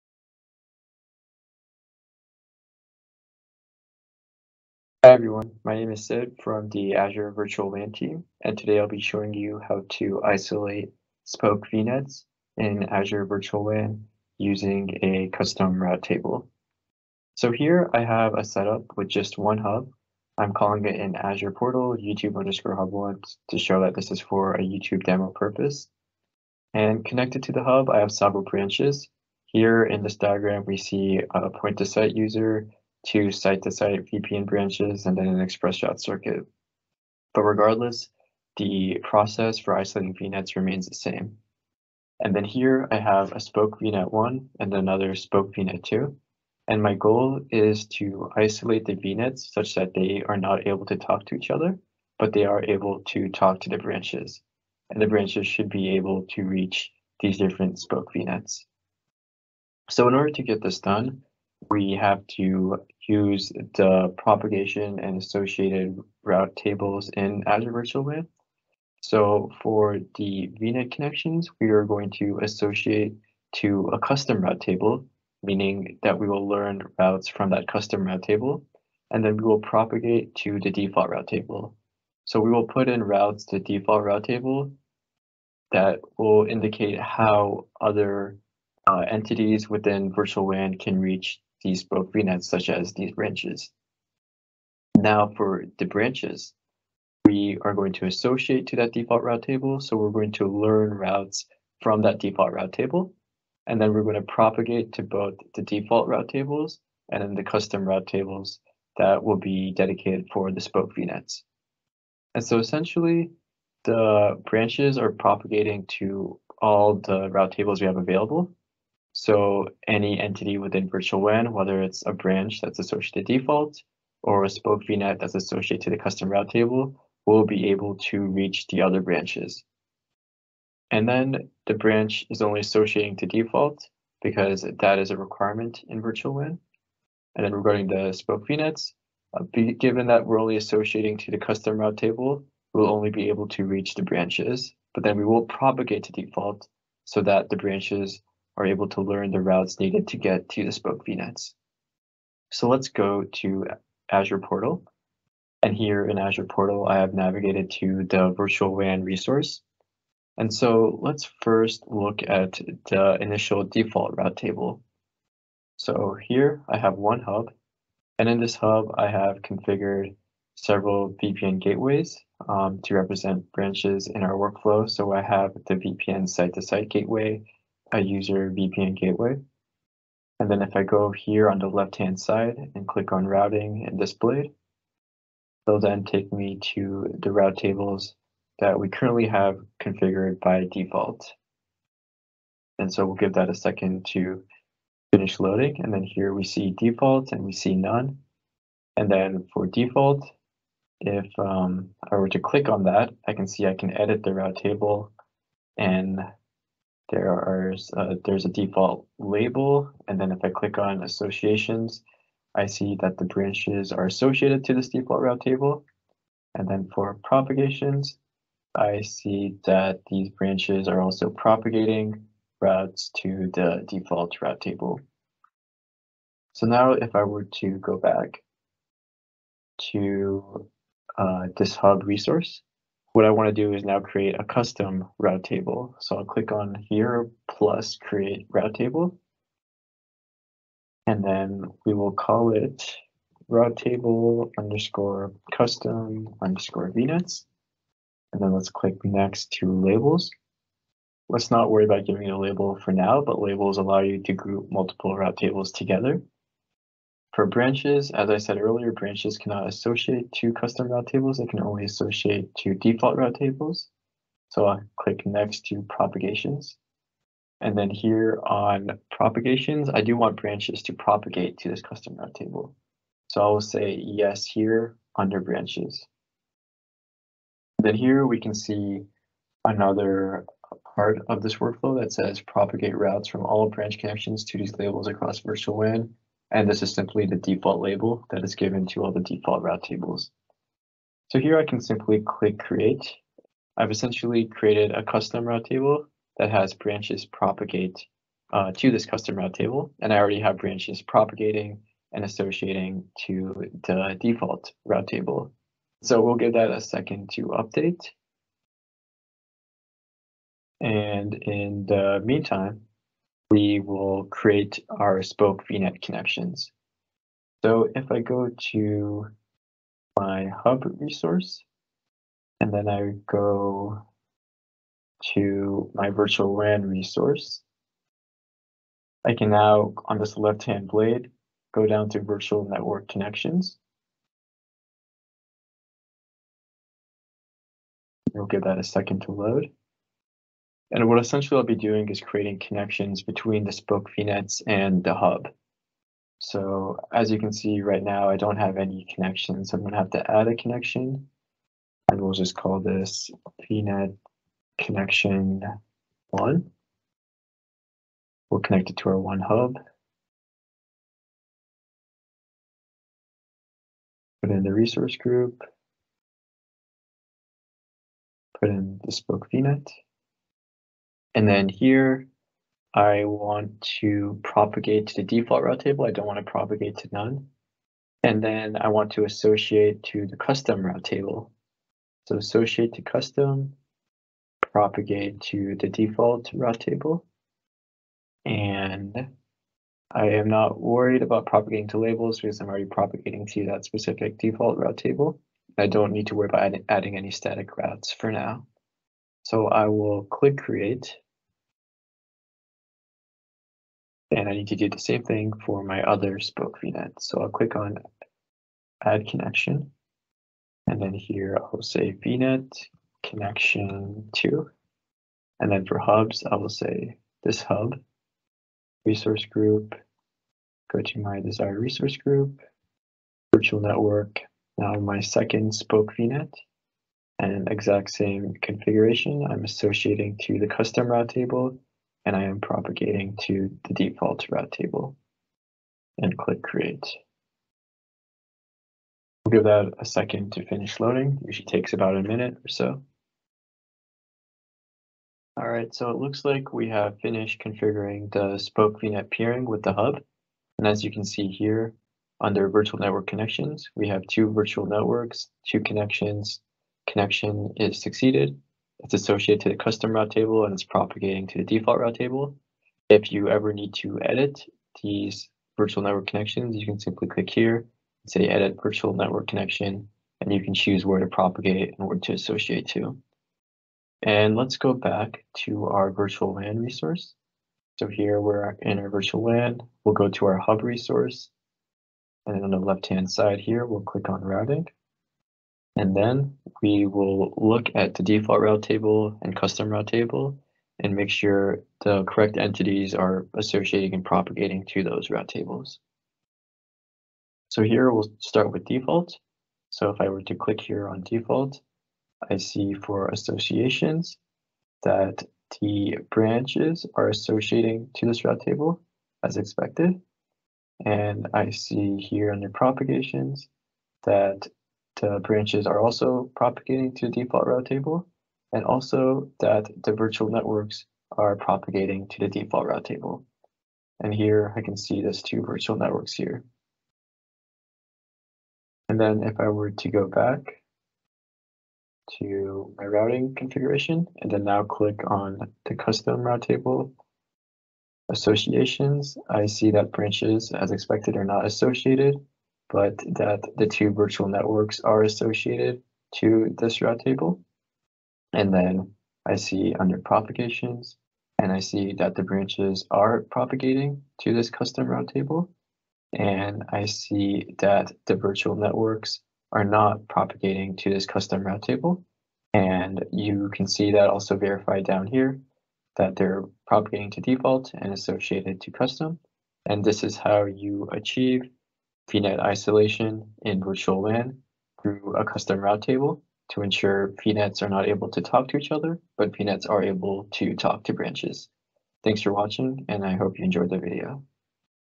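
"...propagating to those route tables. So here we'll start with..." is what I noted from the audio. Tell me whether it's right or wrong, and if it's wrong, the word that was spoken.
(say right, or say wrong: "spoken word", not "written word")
right.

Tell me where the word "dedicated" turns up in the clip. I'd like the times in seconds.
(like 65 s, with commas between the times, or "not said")
109 s.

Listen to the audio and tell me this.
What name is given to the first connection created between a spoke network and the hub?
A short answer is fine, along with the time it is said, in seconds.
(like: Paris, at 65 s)
VNet connection one, at 353 s.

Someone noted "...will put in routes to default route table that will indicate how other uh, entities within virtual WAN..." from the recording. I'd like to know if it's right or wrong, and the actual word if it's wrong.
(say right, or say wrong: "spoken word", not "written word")
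right.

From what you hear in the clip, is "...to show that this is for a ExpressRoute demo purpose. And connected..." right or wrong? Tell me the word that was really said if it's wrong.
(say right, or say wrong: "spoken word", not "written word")
wrong: "YouTube", not "ExpressRoute".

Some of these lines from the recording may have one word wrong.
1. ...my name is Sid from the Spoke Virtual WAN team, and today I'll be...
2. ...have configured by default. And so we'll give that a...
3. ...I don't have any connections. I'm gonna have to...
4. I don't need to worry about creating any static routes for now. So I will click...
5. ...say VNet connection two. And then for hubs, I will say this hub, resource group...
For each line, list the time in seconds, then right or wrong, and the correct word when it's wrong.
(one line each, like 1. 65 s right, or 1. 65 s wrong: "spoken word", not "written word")
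1. 5 s wrong: "Azure", not "Spoke"
2. 189 s right
3. 348 s right
4. 395 s wrong: "adding", not "creating"
5. 411 s right.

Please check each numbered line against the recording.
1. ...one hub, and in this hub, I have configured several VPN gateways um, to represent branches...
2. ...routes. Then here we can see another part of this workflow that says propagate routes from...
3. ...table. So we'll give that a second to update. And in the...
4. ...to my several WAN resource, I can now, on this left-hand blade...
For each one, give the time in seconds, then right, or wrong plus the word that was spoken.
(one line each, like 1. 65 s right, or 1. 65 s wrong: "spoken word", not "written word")
1. 166 s right
2. 275 s wrong: "branches", not "routes"
3. 305 s right
4. 325 s wrong: "virtual", not "several".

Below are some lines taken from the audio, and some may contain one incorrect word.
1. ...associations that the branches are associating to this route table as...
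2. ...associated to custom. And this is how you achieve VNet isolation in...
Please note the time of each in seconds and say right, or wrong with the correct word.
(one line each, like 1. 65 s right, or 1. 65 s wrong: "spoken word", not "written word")
1. 503 s right
2. 568 s right.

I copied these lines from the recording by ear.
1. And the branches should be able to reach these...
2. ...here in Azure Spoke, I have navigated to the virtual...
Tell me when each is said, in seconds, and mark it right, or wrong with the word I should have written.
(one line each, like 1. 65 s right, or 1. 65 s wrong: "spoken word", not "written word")
1. 54 s right
2. 155 s wrong: "Portal", not "Spoke".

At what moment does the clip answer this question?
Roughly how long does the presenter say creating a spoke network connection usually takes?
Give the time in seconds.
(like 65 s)
441 s.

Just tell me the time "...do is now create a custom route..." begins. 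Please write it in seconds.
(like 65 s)
233 s.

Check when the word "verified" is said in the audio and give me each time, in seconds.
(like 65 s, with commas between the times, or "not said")
564 s.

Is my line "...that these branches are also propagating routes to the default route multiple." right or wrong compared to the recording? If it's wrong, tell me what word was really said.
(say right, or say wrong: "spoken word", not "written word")
wrong: "table", not "multiple".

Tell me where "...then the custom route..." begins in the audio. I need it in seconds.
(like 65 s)
107 s.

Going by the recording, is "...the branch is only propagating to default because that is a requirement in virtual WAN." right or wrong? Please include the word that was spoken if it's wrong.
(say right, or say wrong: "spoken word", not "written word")
wrong: "associating", not "propagating".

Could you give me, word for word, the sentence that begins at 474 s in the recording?
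And let's go back to our virtual WAN resource.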